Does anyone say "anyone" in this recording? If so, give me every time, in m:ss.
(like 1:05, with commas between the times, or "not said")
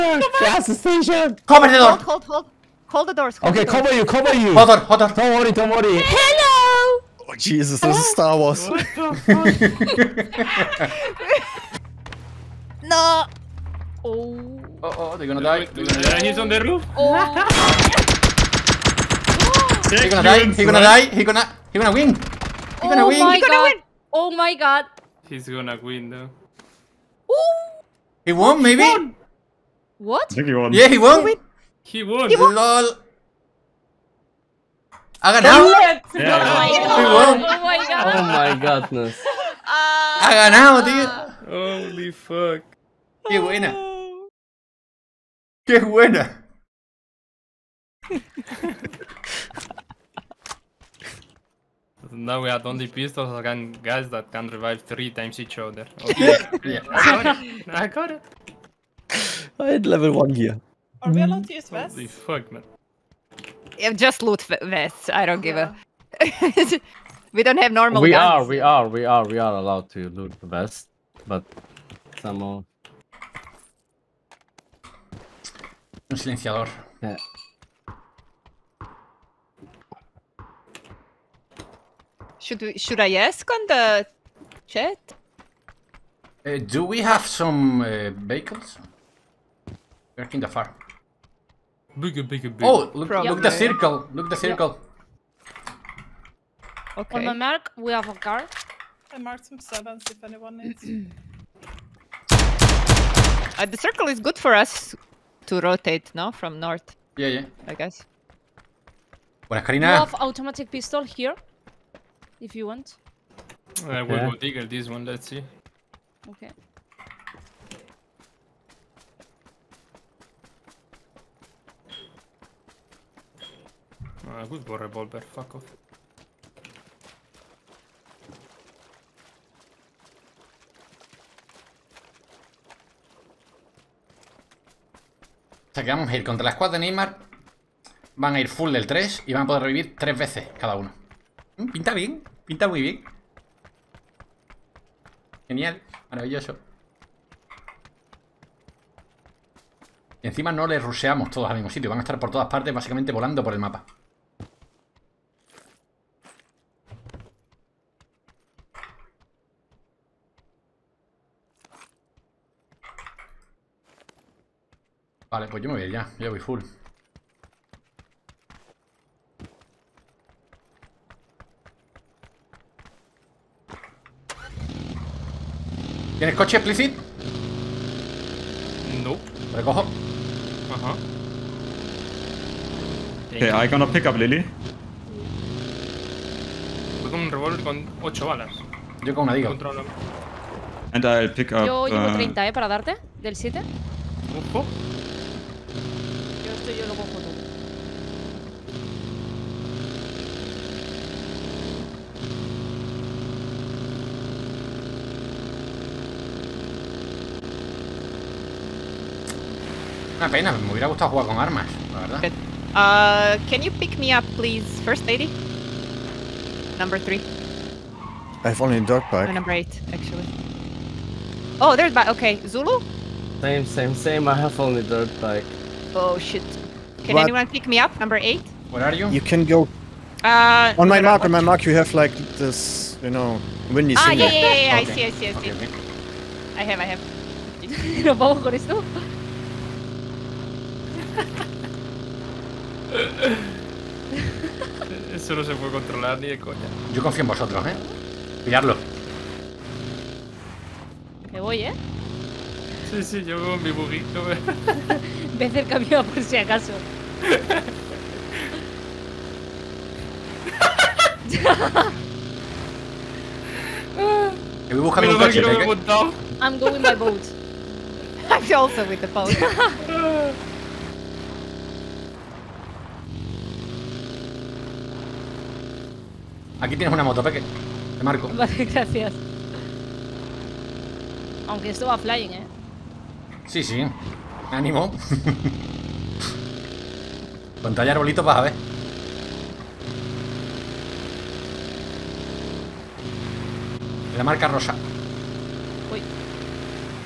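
1:40, 3:47.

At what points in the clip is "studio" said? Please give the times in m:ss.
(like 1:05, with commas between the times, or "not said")
not said.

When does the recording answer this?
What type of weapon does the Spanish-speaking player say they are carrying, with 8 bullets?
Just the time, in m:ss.
3:07.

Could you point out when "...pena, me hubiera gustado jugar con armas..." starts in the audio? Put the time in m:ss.
3:30.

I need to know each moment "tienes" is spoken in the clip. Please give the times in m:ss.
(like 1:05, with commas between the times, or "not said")
2:56, 4:36.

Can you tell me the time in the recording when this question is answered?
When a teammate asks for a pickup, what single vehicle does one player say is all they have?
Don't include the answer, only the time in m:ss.
3:44.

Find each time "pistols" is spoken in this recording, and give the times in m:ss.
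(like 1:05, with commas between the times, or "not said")
0:52, 1:50.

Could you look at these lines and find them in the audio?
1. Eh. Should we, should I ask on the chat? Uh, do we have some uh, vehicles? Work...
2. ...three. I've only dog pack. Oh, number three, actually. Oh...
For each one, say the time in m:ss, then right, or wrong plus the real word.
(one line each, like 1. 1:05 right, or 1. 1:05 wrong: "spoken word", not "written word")
1. 1:17 right
2. 3:36 wrong: "eight", not "three".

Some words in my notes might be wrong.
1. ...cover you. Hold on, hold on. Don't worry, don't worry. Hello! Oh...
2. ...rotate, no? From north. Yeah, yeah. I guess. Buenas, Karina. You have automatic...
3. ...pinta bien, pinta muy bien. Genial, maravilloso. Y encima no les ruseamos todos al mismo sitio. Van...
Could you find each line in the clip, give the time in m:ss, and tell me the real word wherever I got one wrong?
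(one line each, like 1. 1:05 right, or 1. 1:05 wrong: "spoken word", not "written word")
1. 0:04 right
2. 1:45 right
3. 2:21 right.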